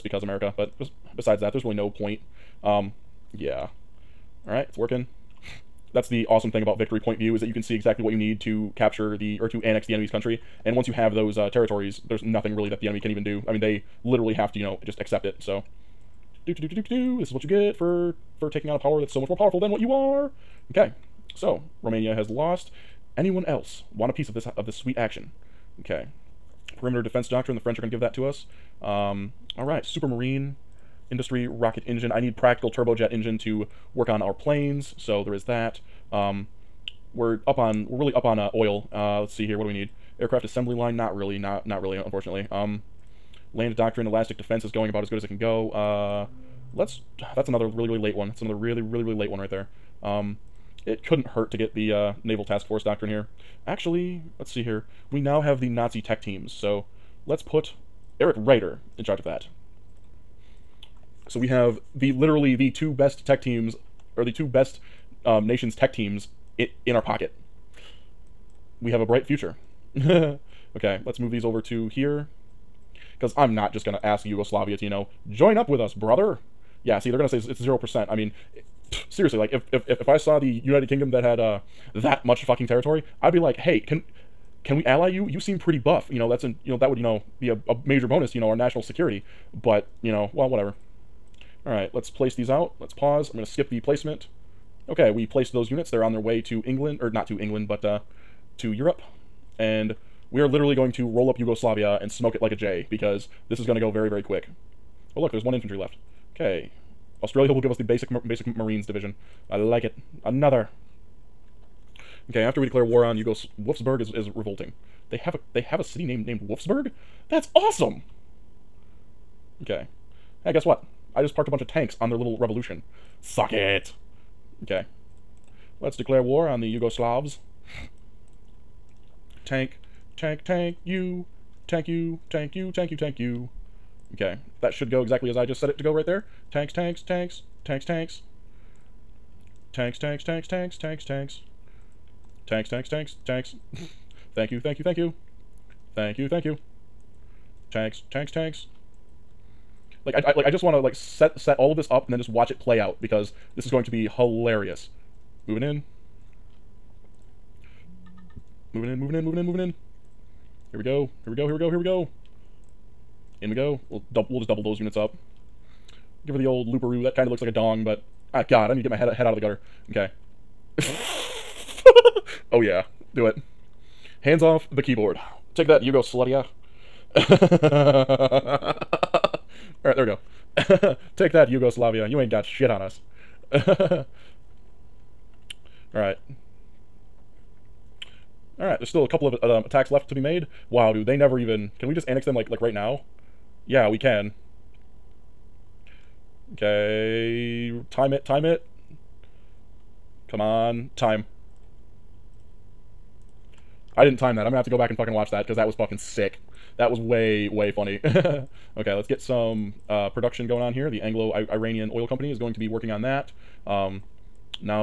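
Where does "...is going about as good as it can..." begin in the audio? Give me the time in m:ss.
0:44.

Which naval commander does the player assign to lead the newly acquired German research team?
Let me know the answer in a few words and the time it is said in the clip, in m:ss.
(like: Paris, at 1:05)
Erich Raeder, at 0:58.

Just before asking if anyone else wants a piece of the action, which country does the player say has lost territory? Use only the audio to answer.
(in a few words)
Romania.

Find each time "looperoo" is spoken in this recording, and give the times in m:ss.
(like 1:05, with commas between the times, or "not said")
2:46.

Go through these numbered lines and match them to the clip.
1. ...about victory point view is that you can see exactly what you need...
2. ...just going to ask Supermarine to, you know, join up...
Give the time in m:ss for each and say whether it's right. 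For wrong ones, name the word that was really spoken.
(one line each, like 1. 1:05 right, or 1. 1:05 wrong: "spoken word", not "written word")
1. 0:06 right
2. 1:13 wrong: "Yugoslavia", not "Supermarine".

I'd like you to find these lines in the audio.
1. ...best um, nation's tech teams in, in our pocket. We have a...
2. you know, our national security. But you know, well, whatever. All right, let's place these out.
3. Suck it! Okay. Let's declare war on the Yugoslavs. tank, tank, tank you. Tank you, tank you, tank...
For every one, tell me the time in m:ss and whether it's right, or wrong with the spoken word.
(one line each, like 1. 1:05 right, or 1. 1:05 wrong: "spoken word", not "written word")
1. 1:04 right
2. 1:28 right
3. 2:03 right.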